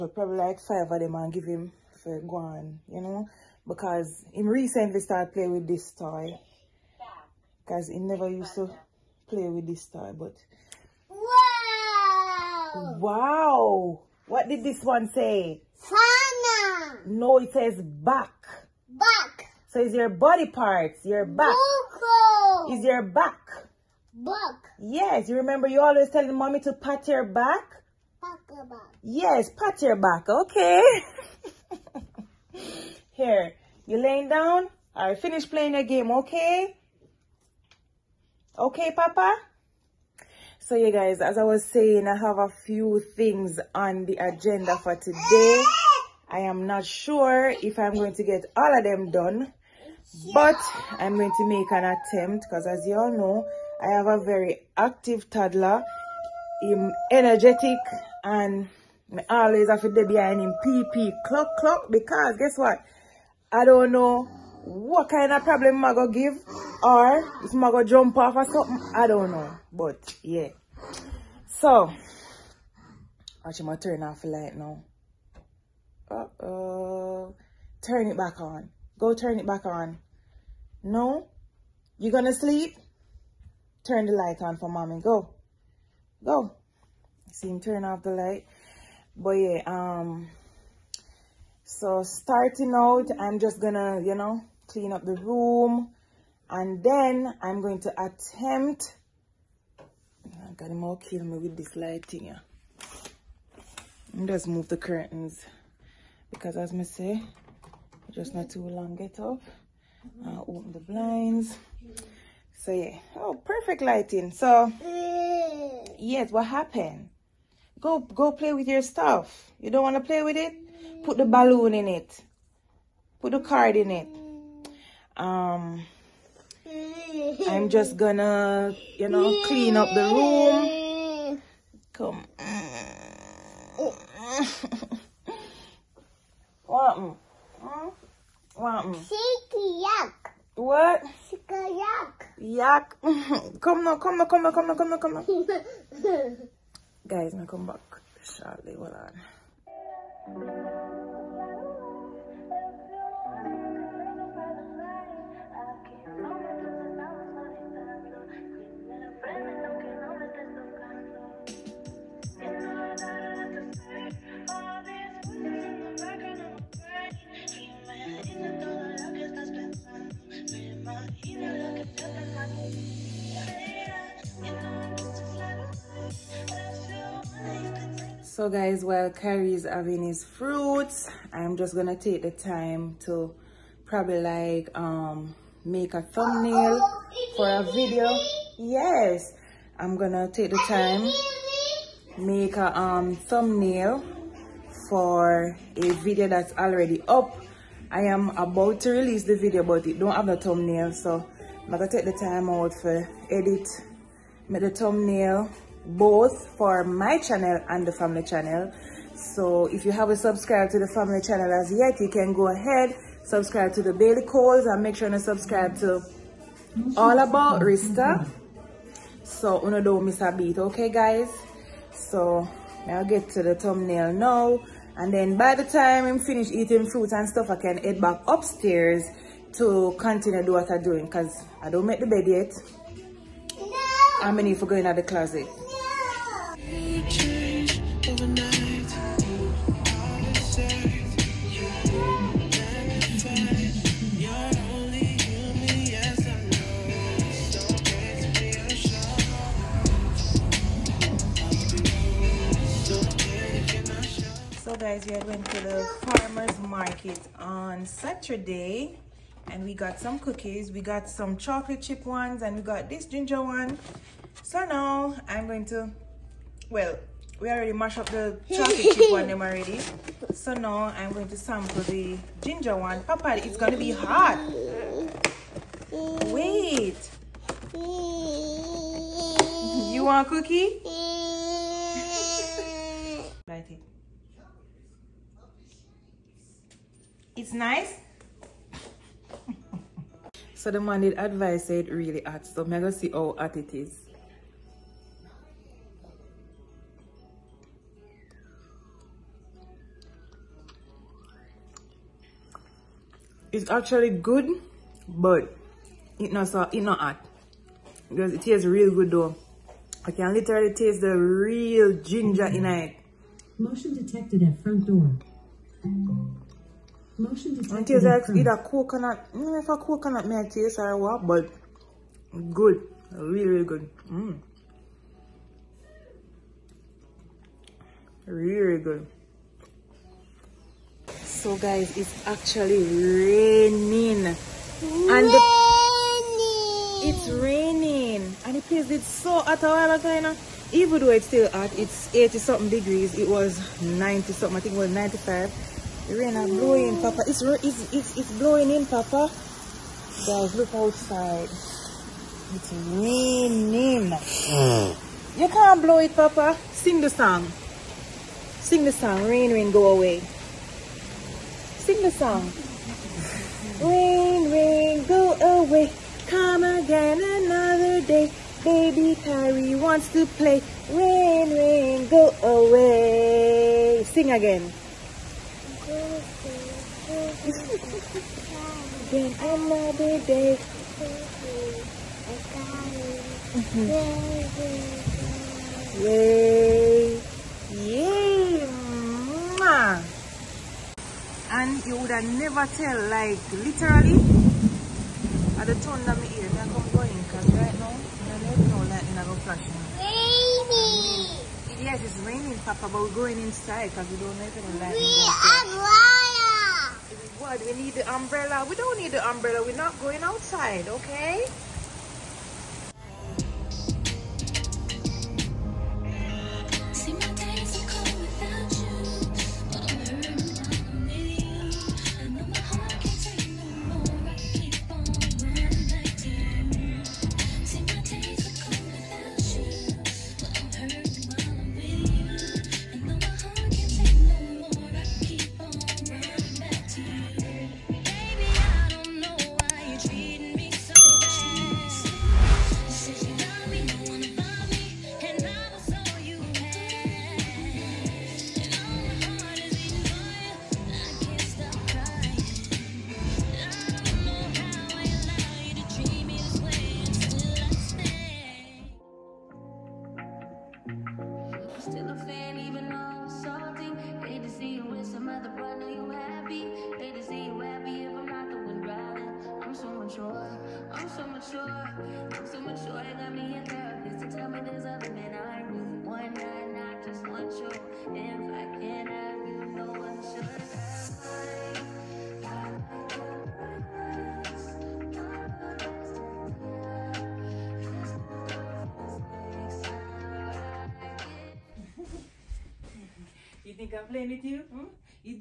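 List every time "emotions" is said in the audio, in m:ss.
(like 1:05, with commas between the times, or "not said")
not said.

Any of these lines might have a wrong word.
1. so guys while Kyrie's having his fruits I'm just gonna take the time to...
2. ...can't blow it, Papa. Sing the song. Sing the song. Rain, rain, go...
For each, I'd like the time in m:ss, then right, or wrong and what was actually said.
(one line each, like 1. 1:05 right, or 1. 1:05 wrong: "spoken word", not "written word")
1. 2:58 right
2. 5:55 right.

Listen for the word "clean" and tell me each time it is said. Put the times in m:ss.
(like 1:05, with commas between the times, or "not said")
1:34, 2:09.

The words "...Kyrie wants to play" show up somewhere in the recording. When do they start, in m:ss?
6:09.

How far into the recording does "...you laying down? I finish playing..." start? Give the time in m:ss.
0:33.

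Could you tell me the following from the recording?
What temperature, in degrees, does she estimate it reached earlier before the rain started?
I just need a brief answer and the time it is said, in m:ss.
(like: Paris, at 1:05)
95, at 5:44.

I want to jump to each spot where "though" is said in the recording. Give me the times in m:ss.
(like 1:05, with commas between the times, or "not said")
5:09, 5:41.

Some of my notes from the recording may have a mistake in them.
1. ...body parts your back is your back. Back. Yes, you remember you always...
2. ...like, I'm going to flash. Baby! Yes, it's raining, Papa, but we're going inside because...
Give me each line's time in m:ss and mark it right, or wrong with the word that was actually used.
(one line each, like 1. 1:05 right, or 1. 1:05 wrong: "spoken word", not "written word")
1. 0:20 right
2. 6:38 right.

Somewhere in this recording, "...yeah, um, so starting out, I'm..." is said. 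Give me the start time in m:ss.
1:29.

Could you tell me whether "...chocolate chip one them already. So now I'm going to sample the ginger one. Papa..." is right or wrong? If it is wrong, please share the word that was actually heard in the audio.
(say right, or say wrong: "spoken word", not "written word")
right.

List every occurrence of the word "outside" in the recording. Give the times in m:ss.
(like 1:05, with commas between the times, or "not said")
5:50, 6:50.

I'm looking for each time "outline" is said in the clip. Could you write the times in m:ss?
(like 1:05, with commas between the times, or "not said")
not said.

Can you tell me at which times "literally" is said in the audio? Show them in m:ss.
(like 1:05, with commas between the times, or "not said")
5:10, 6:33.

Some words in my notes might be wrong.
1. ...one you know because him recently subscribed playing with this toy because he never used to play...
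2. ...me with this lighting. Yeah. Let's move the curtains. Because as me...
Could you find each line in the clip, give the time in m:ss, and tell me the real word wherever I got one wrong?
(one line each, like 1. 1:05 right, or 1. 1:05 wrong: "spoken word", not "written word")
1. 0:02 wrong: "started", not "subscribed"
2. 1:41 right.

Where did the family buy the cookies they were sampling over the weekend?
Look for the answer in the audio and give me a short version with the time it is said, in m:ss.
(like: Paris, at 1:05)
Farmer's market, at 4:16.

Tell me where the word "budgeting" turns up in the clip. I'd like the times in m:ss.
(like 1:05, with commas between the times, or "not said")
not said.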